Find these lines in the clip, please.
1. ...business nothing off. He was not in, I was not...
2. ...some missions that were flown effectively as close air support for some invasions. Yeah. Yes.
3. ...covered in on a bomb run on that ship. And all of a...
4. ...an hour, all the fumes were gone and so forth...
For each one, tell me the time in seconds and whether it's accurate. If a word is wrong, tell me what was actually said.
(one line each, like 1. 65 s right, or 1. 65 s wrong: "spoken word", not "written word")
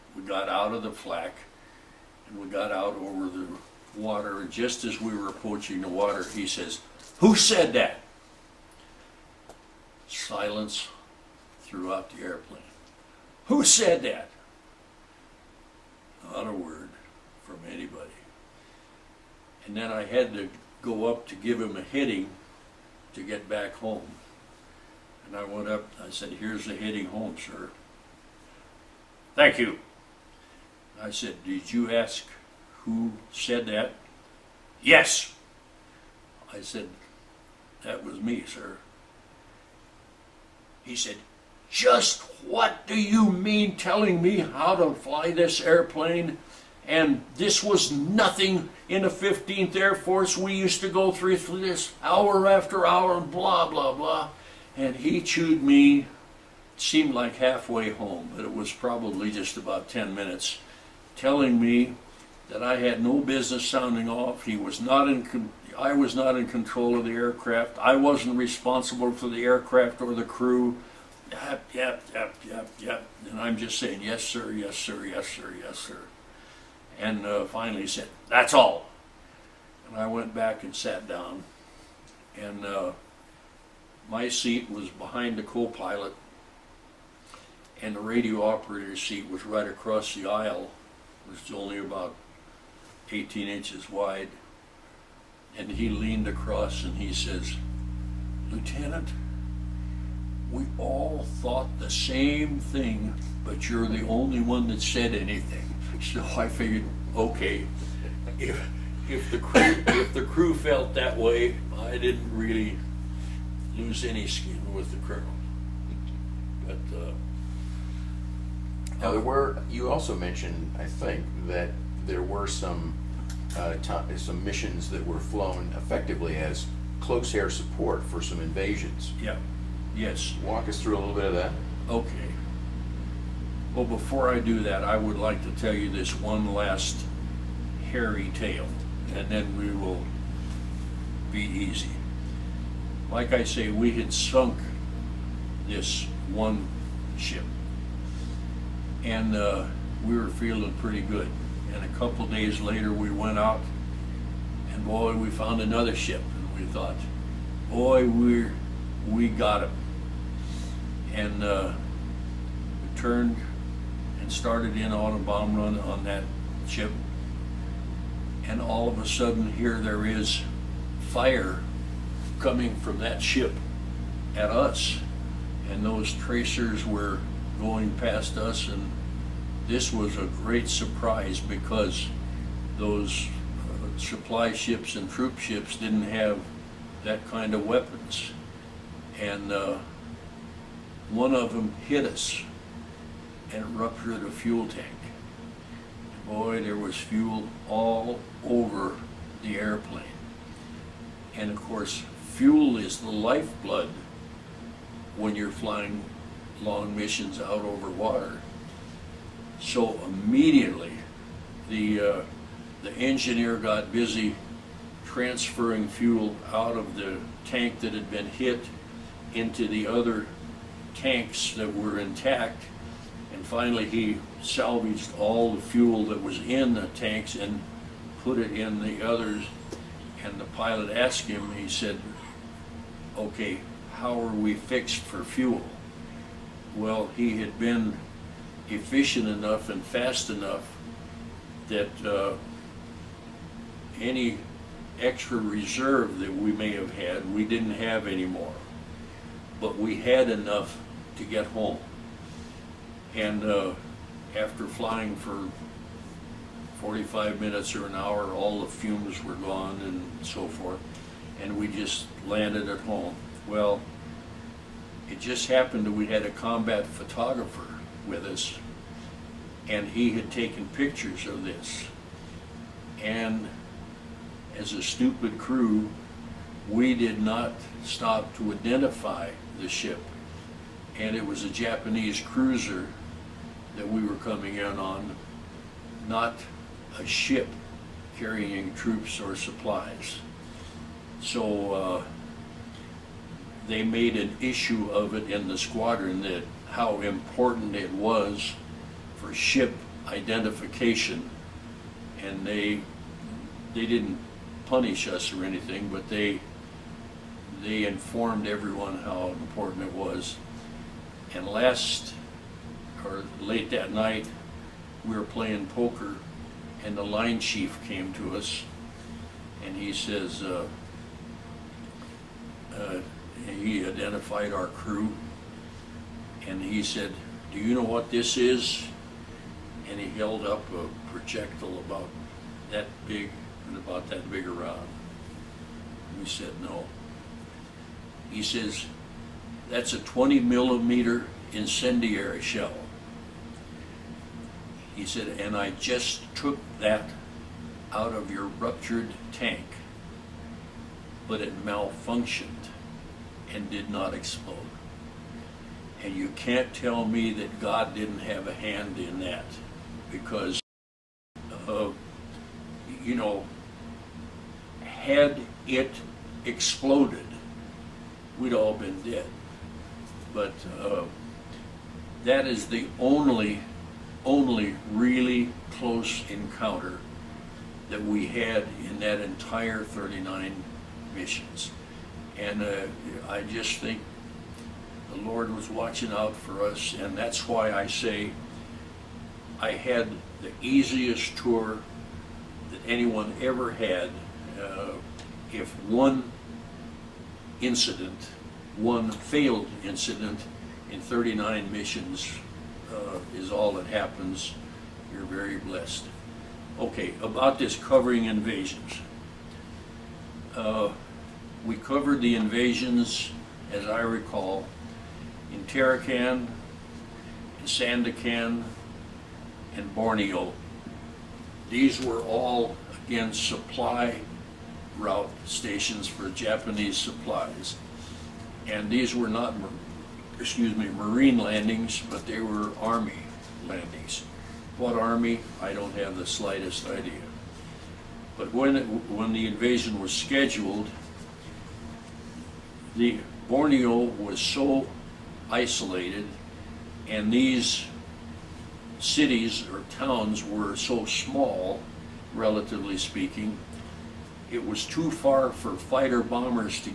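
1. 63 s wrong: "sounding", not "nothing"
2. 124 s right
3. 164 s wrong: "started", not "covered"
4. 257 s right.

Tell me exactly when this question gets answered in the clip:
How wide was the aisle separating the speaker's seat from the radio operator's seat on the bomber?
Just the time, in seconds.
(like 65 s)
93 s.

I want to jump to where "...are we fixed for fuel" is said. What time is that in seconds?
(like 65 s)
234 s.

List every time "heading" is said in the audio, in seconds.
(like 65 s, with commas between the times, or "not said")
21 s, 26 s.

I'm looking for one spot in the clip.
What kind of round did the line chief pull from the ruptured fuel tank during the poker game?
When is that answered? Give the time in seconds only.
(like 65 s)
339 s.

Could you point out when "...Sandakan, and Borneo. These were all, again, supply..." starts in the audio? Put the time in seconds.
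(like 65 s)
417 s.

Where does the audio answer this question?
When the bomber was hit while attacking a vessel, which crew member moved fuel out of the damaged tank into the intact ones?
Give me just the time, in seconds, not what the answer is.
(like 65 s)
212 s.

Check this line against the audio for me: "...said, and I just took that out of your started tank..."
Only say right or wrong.
wrong.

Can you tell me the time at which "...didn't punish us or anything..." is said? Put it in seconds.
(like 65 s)
303 s.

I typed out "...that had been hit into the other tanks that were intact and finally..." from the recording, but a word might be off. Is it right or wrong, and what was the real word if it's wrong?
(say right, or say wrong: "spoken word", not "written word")
right.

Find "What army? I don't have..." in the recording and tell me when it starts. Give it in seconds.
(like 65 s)
434 s.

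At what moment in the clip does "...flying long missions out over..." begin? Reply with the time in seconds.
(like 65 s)
205 s.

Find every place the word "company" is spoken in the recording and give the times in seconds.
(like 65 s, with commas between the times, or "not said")
not said.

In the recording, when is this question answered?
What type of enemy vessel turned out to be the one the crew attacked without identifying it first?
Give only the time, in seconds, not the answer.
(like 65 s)
281 s.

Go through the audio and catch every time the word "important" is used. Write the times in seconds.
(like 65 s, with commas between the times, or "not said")
297 s, 309 s.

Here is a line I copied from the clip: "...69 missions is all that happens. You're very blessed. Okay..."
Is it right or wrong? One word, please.
wrong.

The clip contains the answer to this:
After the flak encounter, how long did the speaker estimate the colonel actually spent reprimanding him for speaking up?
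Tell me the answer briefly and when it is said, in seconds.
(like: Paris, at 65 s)
10 minutes, at 59 s.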